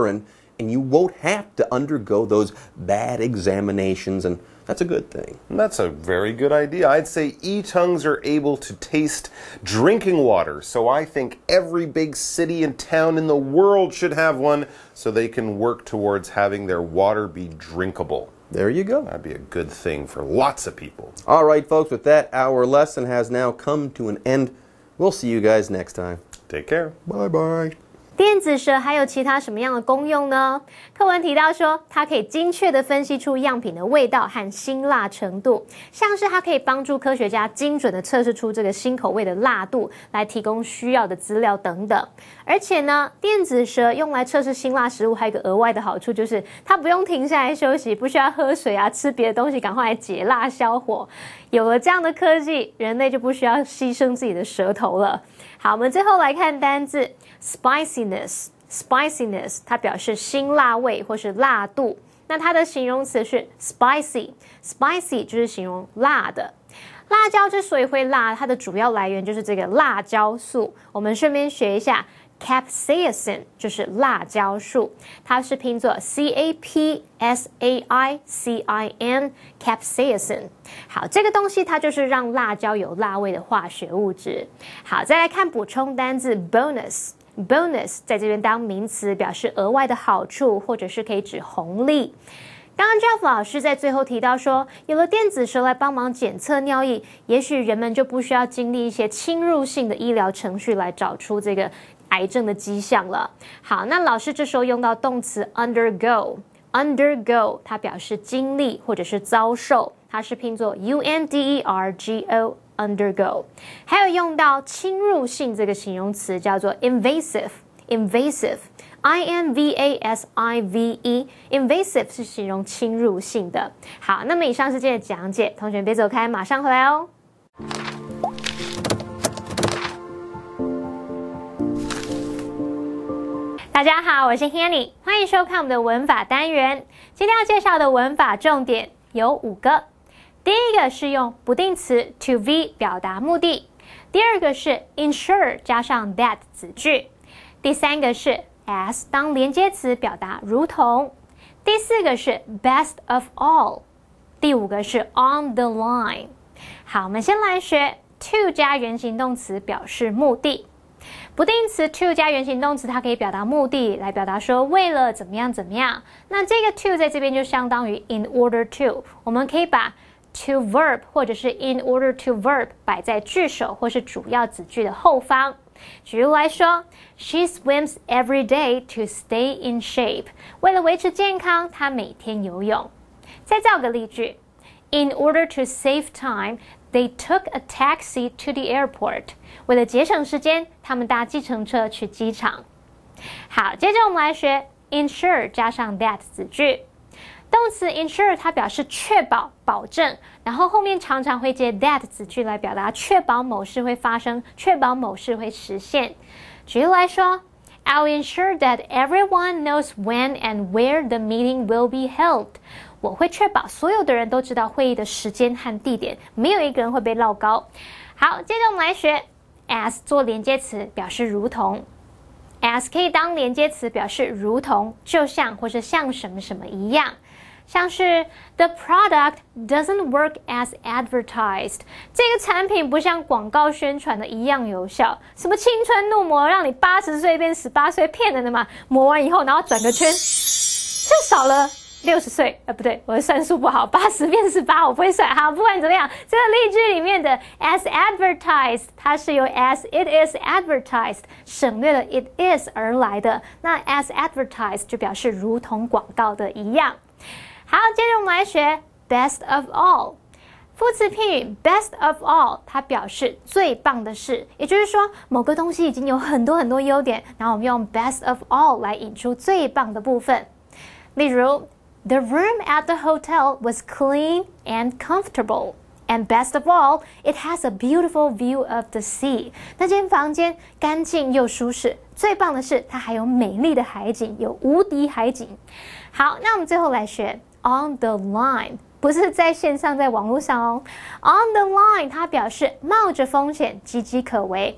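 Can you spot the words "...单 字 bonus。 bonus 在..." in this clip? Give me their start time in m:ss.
1:25.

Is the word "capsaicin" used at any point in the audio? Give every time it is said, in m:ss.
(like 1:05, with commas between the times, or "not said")
1:12, 1:19.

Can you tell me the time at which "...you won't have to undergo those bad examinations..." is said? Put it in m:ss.
0:00.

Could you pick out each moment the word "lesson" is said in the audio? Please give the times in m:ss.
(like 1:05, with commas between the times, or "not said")
0:22.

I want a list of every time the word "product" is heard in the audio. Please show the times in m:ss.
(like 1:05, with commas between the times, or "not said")
3:48.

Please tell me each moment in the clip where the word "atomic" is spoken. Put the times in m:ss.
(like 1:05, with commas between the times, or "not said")
not said.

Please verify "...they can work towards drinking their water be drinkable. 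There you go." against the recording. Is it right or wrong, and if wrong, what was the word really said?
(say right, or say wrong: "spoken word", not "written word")
wrong: "having", not "drinking".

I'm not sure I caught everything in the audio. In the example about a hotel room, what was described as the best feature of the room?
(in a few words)
beautiful view of the sea.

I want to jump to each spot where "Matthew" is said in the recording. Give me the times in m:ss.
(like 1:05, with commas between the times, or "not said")
not said.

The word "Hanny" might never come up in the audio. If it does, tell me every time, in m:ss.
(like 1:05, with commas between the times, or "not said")
2:14.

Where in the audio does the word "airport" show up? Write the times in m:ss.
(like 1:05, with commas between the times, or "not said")
3:08.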